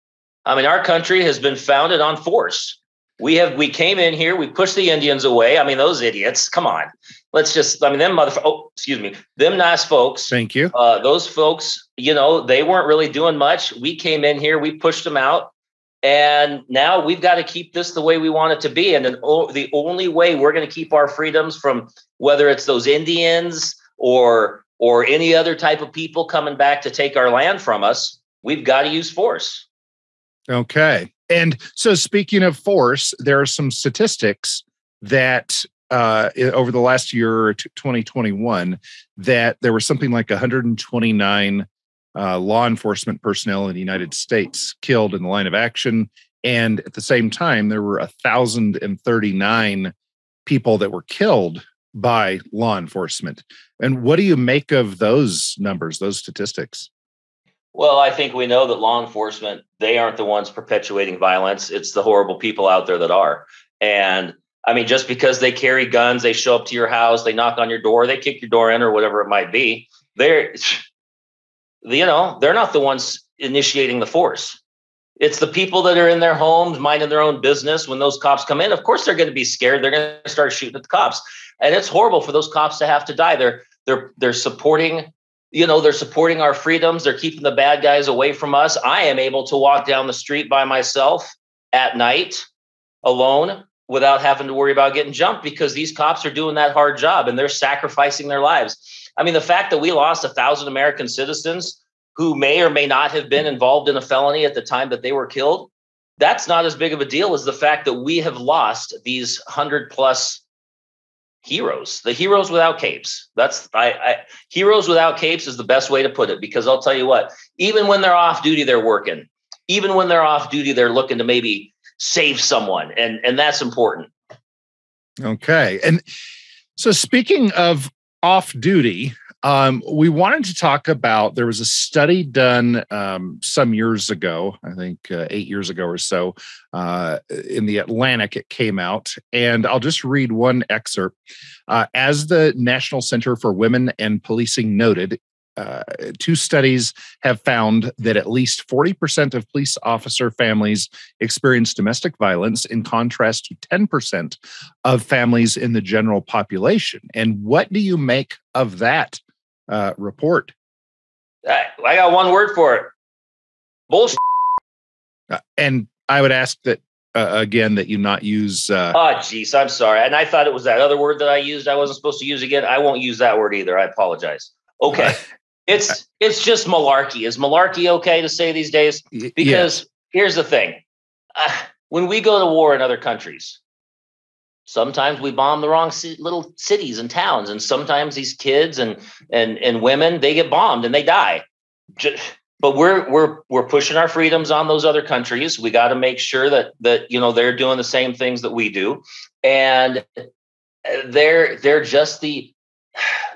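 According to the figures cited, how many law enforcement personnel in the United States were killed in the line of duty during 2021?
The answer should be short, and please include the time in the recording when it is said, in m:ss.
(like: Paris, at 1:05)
129, at 0:40.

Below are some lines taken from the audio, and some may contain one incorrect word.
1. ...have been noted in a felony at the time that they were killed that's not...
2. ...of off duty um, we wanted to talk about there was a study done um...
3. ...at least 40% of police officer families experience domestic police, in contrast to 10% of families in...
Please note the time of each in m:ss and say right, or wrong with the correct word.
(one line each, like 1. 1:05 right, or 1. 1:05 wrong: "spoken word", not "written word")
1. 1:43 wrong: "involved", not "noted"
2. 2:07 right
3. 2:28 wrong: "violence", not "police".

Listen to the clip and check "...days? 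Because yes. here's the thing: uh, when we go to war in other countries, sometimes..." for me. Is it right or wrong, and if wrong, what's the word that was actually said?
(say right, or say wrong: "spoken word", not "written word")
right.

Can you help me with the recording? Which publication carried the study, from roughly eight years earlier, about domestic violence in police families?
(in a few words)
The Atlantic.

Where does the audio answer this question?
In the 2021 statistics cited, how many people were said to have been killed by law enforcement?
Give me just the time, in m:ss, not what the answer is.
0:47.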